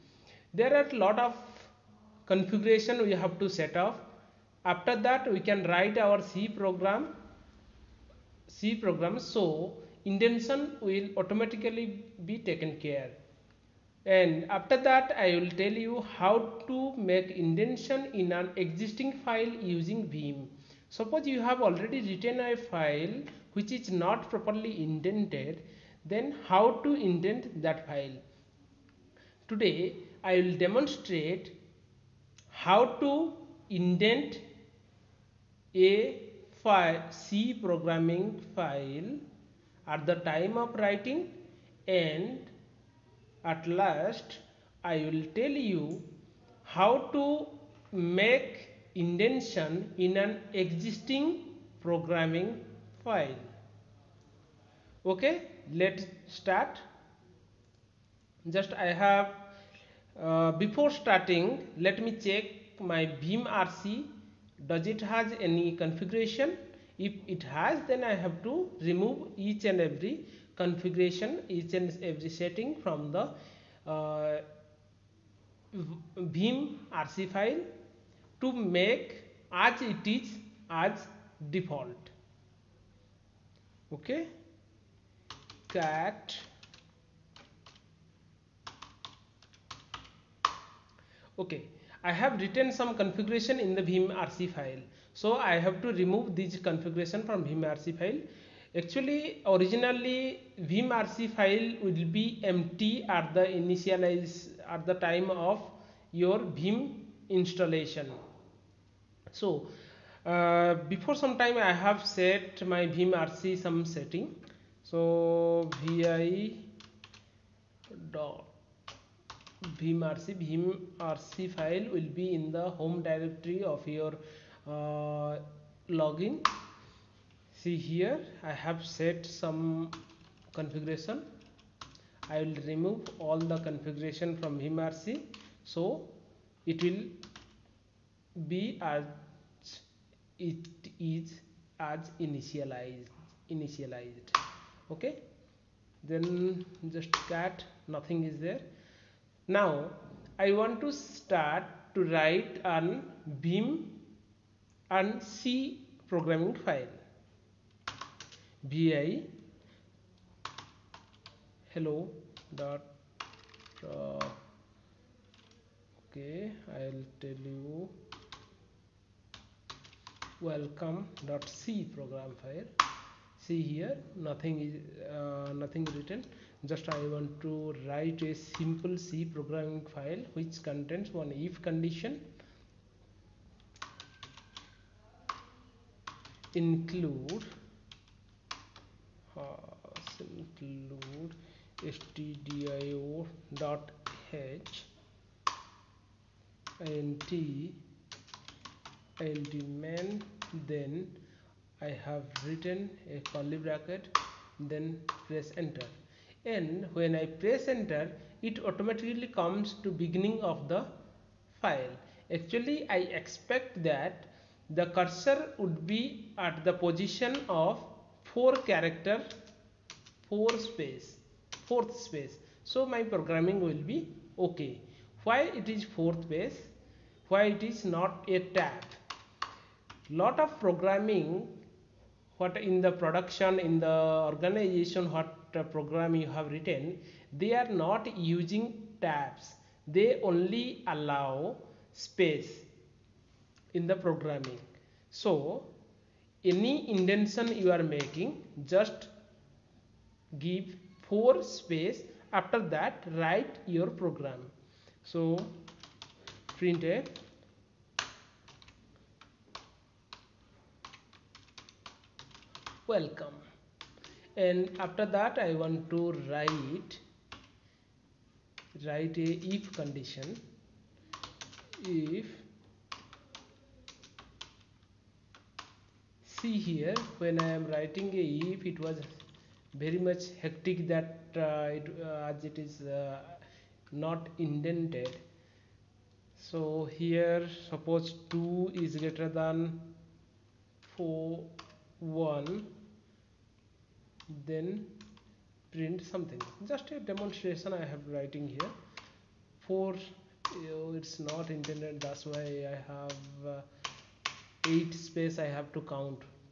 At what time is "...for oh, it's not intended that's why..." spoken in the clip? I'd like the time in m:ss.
4:59.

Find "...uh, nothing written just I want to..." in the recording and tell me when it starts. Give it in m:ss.
2:55.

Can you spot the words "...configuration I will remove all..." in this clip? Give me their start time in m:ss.
2:10.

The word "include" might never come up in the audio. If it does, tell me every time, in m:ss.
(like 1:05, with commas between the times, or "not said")
3:06, 3:10.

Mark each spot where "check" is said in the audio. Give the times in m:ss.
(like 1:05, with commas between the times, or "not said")
1:02.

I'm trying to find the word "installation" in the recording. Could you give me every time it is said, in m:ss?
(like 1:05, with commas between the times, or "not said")
1:47.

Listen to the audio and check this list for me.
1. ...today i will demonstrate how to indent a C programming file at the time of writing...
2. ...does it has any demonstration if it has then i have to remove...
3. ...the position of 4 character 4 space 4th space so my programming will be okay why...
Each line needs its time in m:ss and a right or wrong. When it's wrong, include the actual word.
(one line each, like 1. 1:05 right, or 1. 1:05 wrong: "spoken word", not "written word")
1. 0:29 right
2. 1:04 wrong: "configuration", not "demonstration"
3. 3:36 right.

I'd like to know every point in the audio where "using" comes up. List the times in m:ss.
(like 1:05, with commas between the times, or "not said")
0:19, 3:58.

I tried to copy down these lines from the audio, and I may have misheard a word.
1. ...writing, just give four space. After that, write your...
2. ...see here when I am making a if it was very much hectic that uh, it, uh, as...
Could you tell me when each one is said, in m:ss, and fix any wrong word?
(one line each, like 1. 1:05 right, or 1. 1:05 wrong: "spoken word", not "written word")
1. 4:07 wrong: "making", not "writing"
2. 4:36 wrong: "writing", not "making".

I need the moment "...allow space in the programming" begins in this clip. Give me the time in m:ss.
4:00.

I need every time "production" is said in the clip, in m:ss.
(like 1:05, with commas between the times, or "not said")
3:52.